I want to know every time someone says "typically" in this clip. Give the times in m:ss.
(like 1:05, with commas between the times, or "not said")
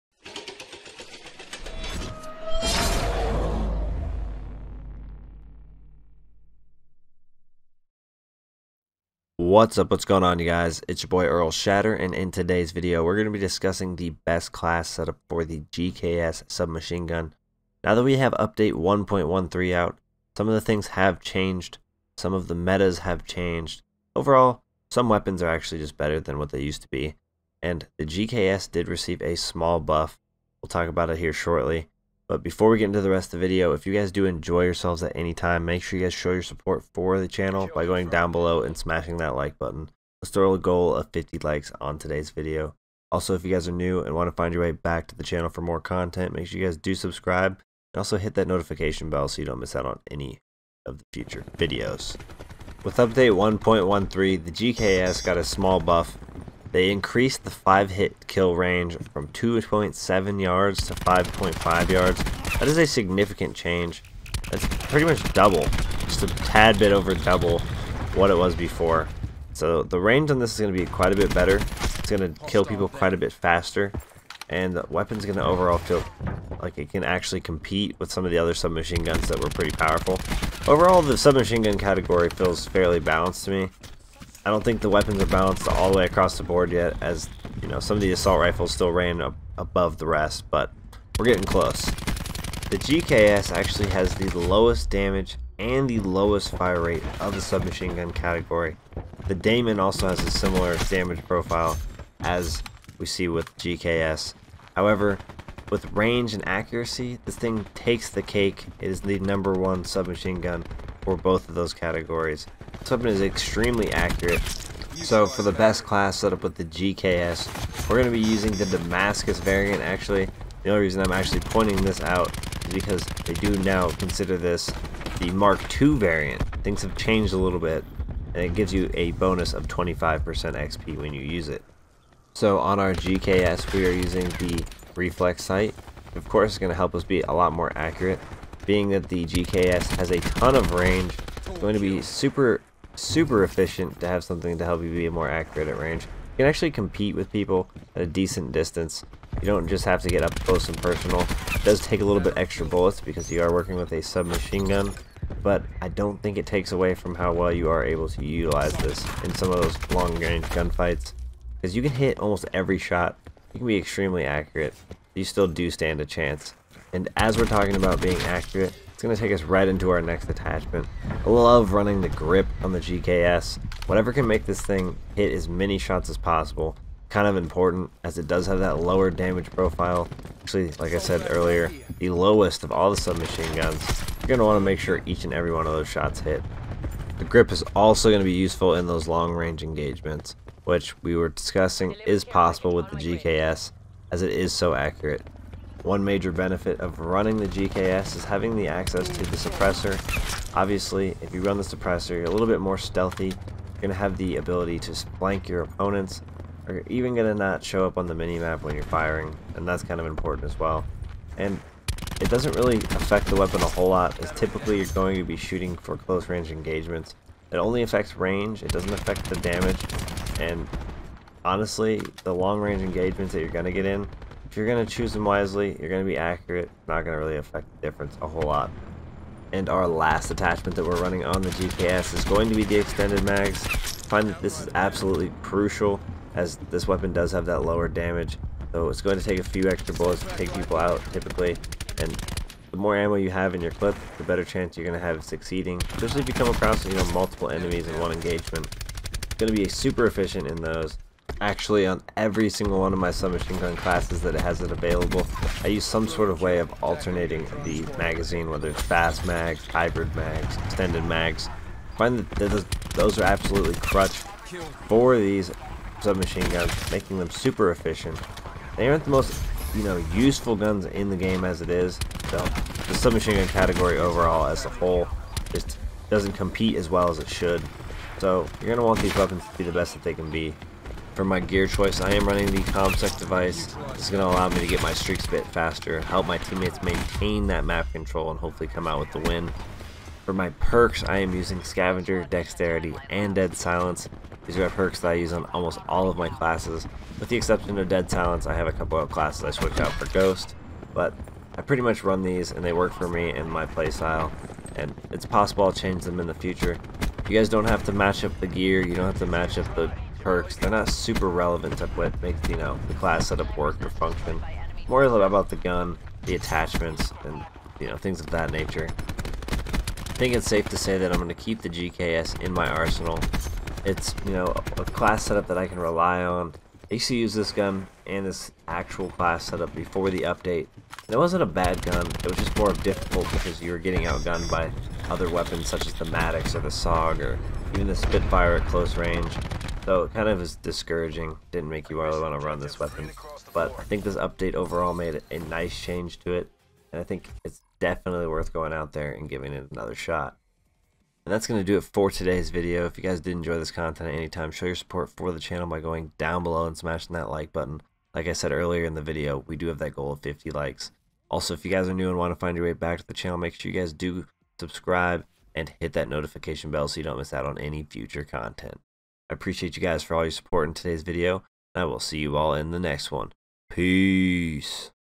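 3:34, 4:01.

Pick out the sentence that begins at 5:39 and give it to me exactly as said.
So it kind of is discouraging, didn't make you really want to run this weapon.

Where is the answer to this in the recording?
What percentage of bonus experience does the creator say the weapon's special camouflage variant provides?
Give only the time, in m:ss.
2:09.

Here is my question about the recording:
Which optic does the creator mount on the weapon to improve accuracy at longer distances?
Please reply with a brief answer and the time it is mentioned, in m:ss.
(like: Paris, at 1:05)
reflex sight, at 2:14.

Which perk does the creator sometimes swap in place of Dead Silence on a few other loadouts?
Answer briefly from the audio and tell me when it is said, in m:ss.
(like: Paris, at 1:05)
Ghost, at 5:00.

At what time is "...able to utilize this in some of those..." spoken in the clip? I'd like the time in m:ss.
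2:37.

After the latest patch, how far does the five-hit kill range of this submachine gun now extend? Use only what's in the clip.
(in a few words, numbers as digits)
5.5 yards.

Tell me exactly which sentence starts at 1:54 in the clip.
So for the best class setup with the GKS, we're going to be using the Damascus variant actually.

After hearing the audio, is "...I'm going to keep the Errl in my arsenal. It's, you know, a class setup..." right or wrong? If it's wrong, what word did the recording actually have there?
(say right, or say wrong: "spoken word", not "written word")
wrong: "GKS", not "Errl".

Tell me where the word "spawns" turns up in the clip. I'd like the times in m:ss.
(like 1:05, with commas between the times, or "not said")
not said.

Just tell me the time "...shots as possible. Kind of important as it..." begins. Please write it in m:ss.
2:55.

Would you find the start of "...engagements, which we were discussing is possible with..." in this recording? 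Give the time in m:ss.
3:09.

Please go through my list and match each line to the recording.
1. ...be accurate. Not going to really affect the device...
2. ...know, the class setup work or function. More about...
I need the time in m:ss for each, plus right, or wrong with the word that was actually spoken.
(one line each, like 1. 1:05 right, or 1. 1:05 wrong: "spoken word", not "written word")
1. 3:46 wrong: "difference", not "device"
2. 5:12 right.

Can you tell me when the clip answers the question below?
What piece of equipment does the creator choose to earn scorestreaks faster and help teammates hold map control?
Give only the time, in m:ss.
4:42.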